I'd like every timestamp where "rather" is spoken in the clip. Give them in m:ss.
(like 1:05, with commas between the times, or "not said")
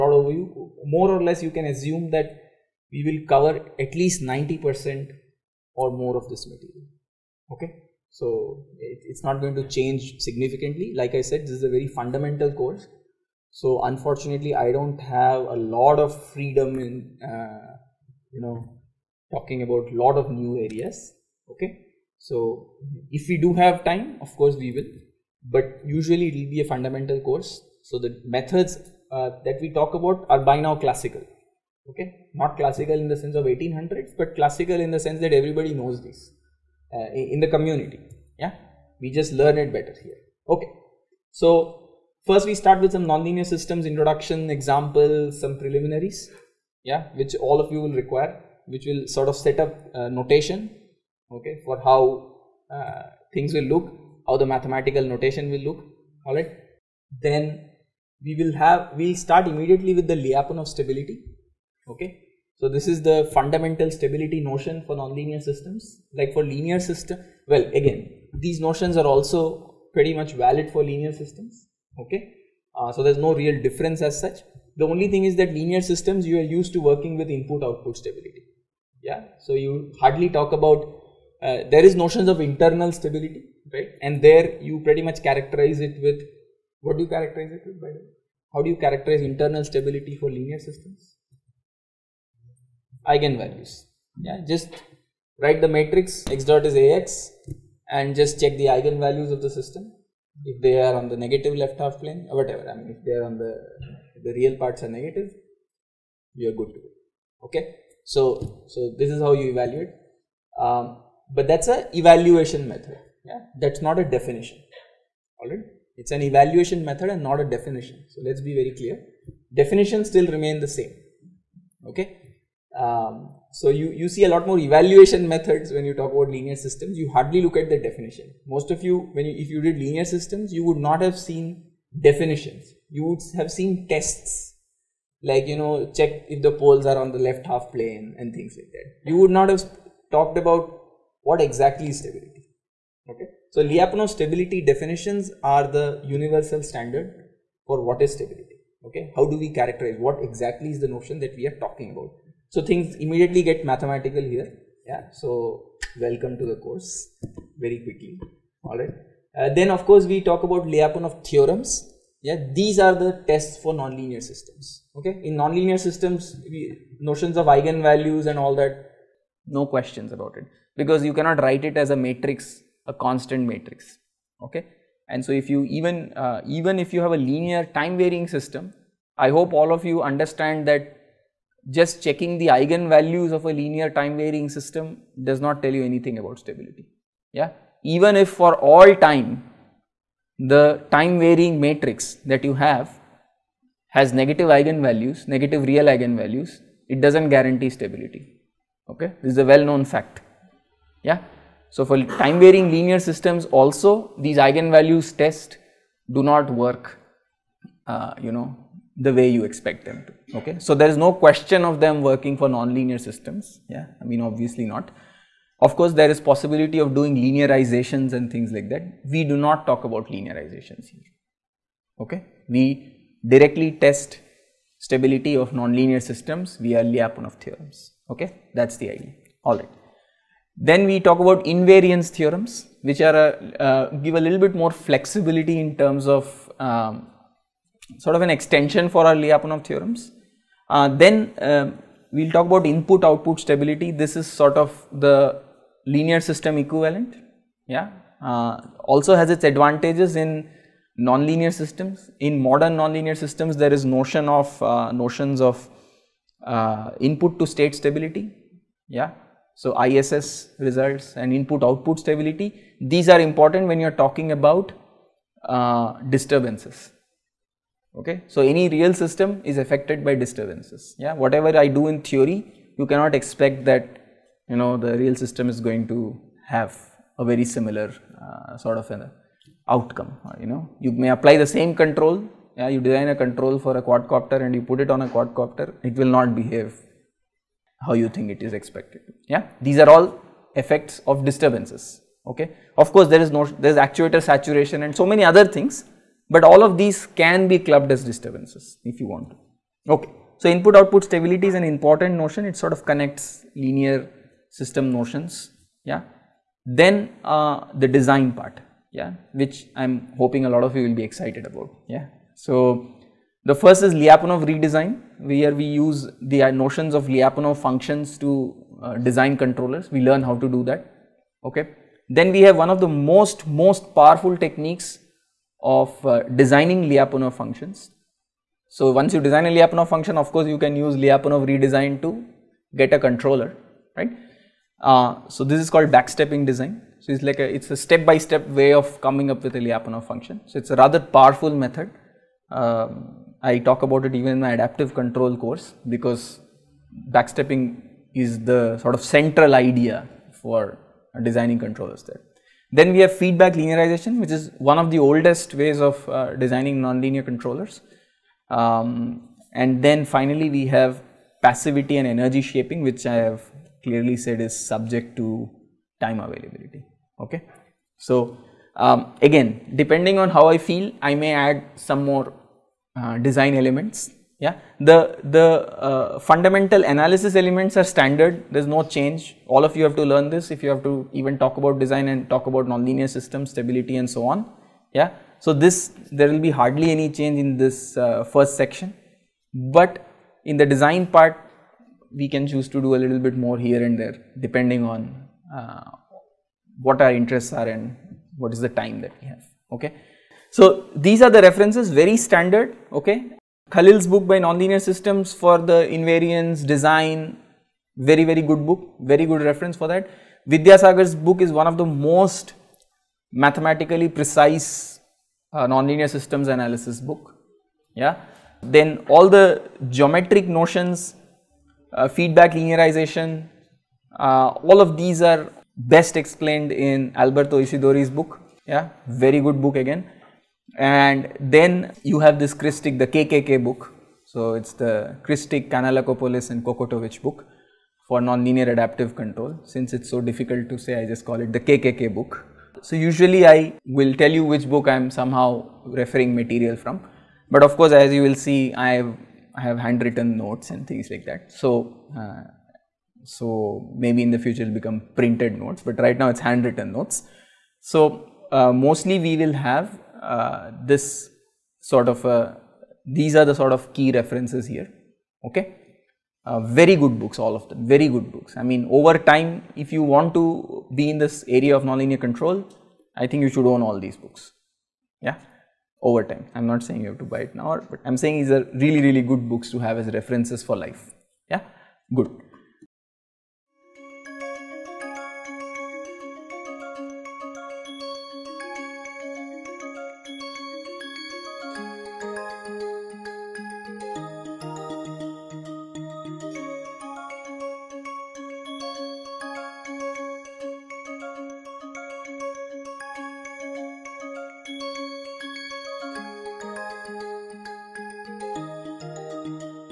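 5:40.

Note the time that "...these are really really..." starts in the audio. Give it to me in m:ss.
7:58.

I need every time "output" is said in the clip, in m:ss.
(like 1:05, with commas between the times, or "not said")
1:17, 4:03, 4:21, 5:00.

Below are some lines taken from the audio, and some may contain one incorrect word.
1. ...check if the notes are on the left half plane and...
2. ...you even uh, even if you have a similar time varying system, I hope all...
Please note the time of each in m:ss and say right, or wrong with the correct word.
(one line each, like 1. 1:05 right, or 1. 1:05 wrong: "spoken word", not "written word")
1. 2:15 wrong: "poles", not "notes"
2. 2:55 wrong: "linear", not "similar".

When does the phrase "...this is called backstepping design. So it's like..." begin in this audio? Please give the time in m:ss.
5:35.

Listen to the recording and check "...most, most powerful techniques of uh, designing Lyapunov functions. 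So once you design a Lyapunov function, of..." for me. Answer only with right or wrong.
right.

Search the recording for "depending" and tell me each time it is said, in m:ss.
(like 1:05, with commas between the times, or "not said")
6:09, 6:34.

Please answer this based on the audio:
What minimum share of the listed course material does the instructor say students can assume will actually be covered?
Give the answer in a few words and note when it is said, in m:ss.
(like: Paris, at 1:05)
90 percent, at 0:04.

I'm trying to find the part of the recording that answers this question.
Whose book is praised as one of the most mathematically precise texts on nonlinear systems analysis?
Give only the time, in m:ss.
6:50.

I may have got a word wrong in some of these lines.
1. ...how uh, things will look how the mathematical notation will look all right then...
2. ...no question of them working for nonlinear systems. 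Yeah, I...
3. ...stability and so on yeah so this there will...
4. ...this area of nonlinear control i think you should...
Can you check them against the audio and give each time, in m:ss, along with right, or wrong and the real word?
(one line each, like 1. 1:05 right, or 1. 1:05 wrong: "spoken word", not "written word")
1. 0:51 right
2. 3:30 right
3. 6:23 right
4. 7:51 right.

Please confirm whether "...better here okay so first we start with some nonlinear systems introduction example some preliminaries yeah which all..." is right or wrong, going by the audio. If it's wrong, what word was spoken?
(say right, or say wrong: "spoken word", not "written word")
right.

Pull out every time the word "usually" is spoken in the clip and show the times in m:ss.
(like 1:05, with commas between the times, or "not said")
0:25, 7:22.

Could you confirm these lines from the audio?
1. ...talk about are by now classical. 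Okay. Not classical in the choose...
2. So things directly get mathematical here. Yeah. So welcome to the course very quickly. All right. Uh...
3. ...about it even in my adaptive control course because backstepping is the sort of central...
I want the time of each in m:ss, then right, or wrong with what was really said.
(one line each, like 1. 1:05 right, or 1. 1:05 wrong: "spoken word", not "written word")
1. 0:29 wrong: "sense", not "choose"
2. 2:32 wrong: "immediately", not "directly"
3. 5:43 right.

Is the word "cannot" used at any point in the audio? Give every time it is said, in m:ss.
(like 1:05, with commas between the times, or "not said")
2:51, 4:32.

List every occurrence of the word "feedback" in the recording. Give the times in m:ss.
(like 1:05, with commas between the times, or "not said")
5:53, 7:02.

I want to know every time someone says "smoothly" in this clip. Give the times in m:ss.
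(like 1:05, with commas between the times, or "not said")
not said.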